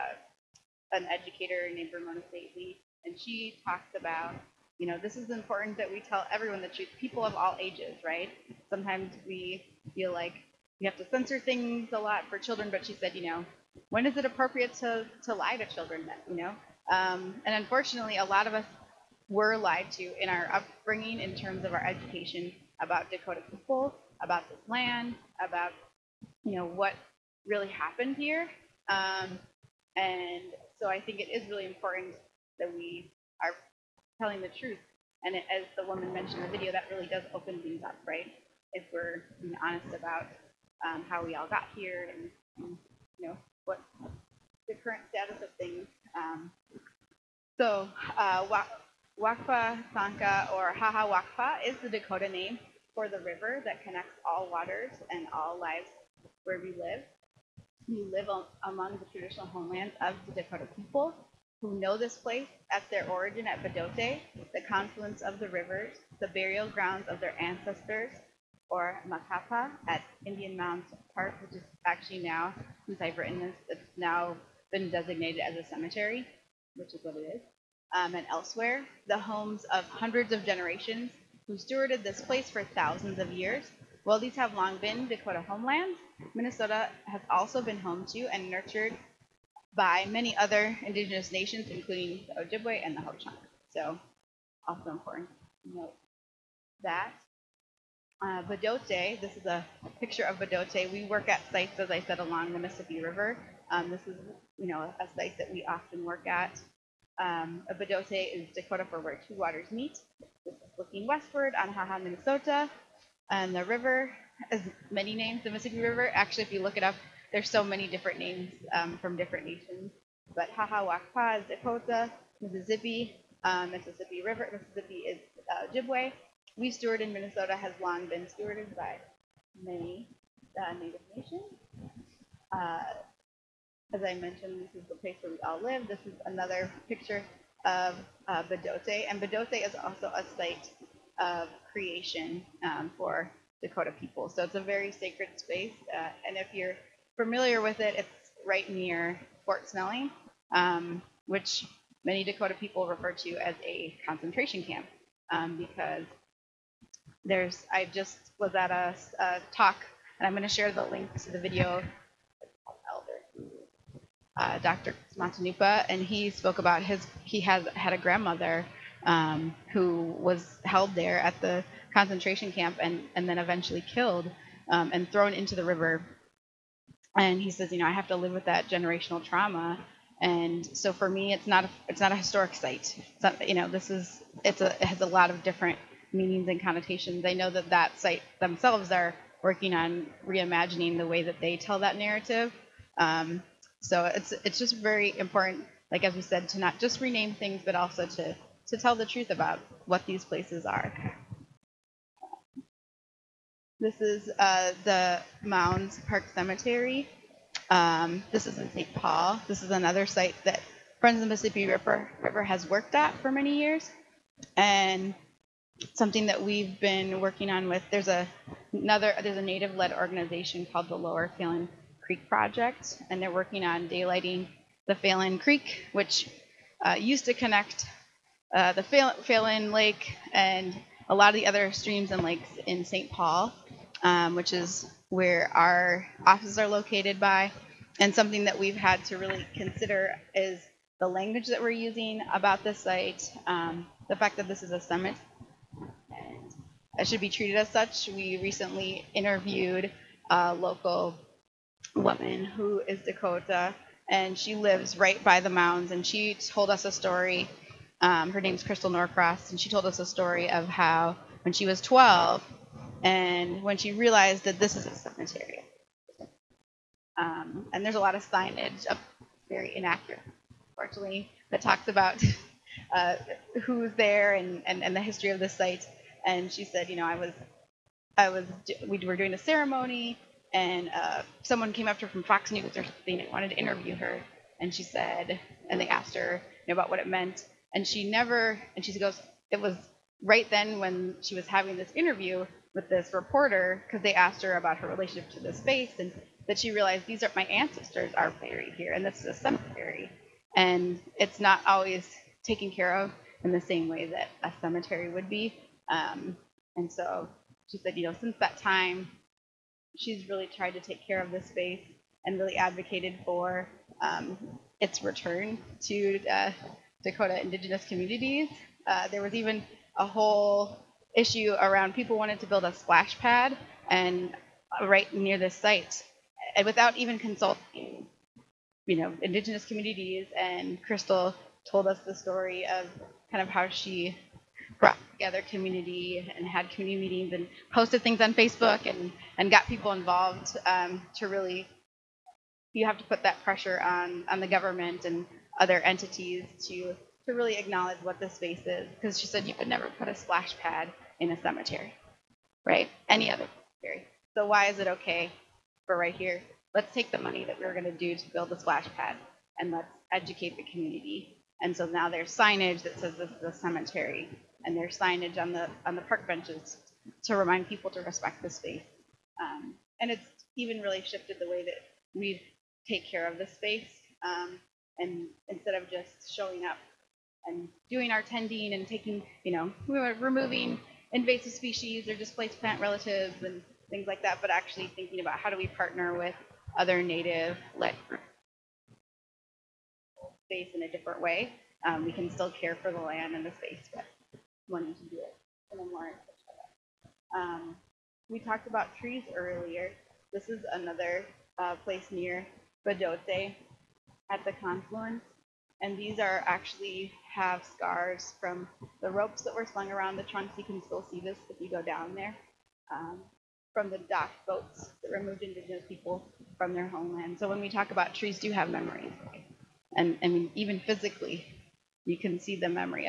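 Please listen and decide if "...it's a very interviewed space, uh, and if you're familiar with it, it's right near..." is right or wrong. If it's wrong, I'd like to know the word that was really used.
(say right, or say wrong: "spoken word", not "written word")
wrong: "sacred", not "interviewed".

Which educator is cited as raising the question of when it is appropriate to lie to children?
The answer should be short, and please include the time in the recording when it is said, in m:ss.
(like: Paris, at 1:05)
Ramona Stately, at 0:01.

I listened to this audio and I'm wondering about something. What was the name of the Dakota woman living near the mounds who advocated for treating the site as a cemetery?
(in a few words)
Crystal Norcross.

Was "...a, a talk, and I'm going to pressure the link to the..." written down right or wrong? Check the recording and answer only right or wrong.
wrong.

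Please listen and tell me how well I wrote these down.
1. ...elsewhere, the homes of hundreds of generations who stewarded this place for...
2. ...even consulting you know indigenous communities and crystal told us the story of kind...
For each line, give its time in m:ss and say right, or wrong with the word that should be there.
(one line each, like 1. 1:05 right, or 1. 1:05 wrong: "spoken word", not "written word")
1. 1:18 right
2. 5:26 right.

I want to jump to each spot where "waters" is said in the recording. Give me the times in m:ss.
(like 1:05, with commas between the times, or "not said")
0:54, 1:49.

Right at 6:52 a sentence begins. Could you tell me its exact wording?
Um, from the dock boats that removed indigenous people from their homeland.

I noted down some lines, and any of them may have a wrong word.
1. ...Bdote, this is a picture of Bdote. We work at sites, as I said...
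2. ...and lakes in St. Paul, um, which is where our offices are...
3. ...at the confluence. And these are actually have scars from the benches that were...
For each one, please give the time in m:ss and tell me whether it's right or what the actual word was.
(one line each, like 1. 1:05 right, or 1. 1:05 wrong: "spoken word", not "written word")
1. 1:38 right
2. 3:52 right
3. 6:44 wrong: "ropes", not "benches".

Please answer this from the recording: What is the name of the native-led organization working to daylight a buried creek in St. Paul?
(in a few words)
Lower Phalen Creek project.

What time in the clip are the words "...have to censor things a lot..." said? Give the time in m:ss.
0:10.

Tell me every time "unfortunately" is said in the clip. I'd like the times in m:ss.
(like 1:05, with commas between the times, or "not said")
0:17, 4:30.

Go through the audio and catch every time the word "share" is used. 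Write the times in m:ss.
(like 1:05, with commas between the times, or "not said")
2:40.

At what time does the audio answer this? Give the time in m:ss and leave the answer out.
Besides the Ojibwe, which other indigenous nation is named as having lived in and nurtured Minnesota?
1:33.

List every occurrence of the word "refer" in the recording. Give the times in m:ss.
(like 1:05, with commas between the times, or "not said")
2:32.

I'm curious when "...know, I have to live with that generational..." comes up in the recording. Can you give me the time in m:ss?
2:57.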